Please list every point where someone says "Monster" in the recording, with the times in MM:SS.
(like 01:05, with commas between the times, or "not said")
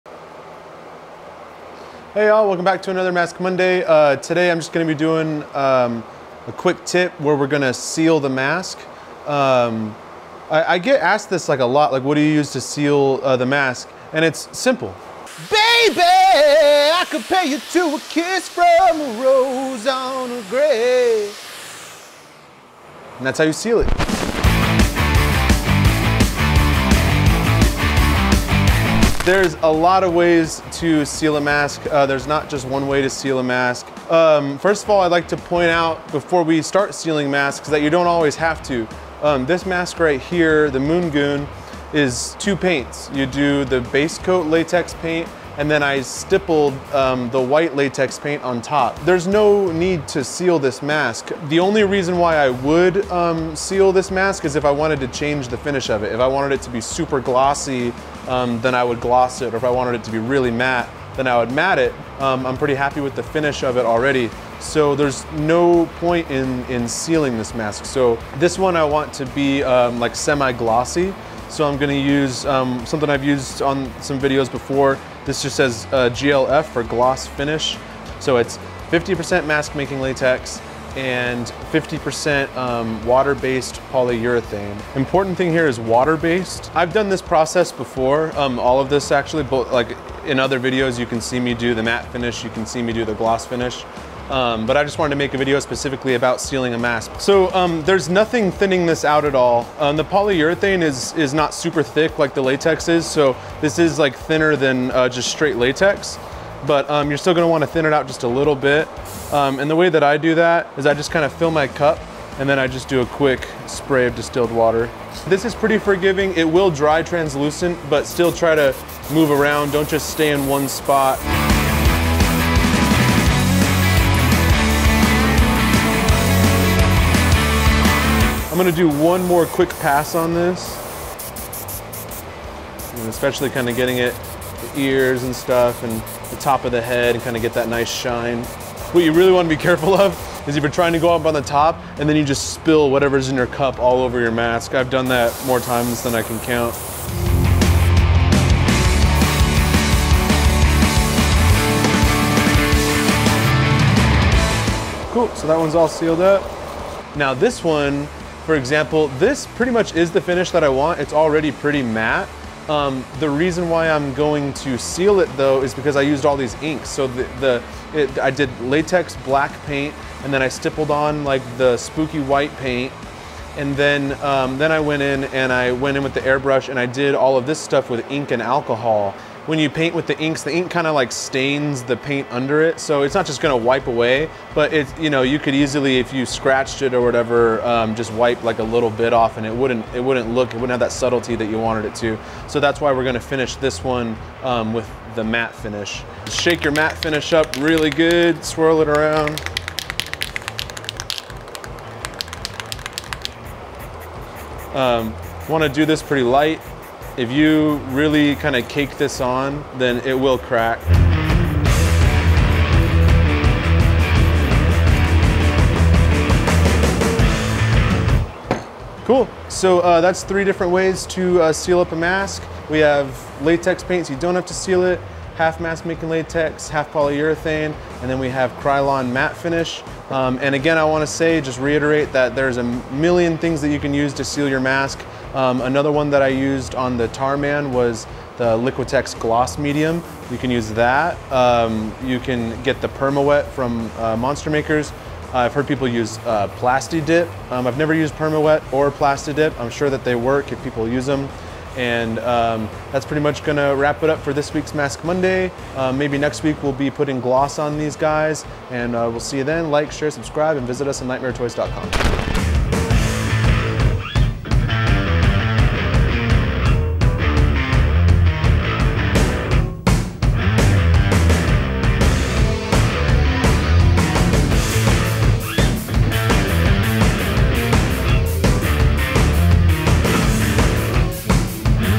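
04:04.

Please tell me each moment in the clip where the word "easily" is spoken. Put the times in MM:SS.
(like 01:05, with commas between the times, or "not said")
03:05.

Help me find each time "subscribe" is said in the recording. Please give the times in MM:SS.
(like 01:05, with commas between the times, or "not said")
04:20.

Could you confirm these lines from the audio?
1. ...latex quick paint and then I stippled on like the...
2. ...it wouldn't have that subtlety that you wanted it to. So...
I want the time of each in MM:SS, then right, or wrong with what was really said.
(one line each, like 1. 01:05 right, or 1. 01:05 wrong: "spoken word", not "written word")
1. 02:48 wrong: "black", not "quick"
2. 03:10 right.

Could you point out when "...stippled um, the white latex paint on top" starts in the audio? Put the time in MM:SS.
00:46.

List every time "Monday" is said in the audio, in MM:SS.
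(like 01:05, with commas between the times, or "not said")
00:03, 04:15.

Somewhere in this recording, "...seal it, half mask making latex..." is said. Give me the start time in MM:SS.
03:44.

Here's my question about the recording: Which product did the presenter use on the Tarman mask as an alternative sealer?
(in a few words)
Liquitex Gloss Medium.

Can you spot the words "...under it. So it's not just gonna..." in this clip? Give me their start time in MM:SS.
03:02.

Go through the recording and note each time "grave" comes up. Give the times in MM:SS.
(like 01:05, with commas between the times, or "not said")
00:20.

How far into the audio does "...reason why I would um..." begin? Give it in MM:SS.
00:51.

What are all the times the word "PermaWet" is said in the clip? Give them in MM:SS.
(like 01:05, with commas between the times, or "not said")
04:02, 04:08.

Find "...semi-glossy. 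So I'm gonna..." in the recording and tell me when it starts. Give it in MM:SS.
01:10.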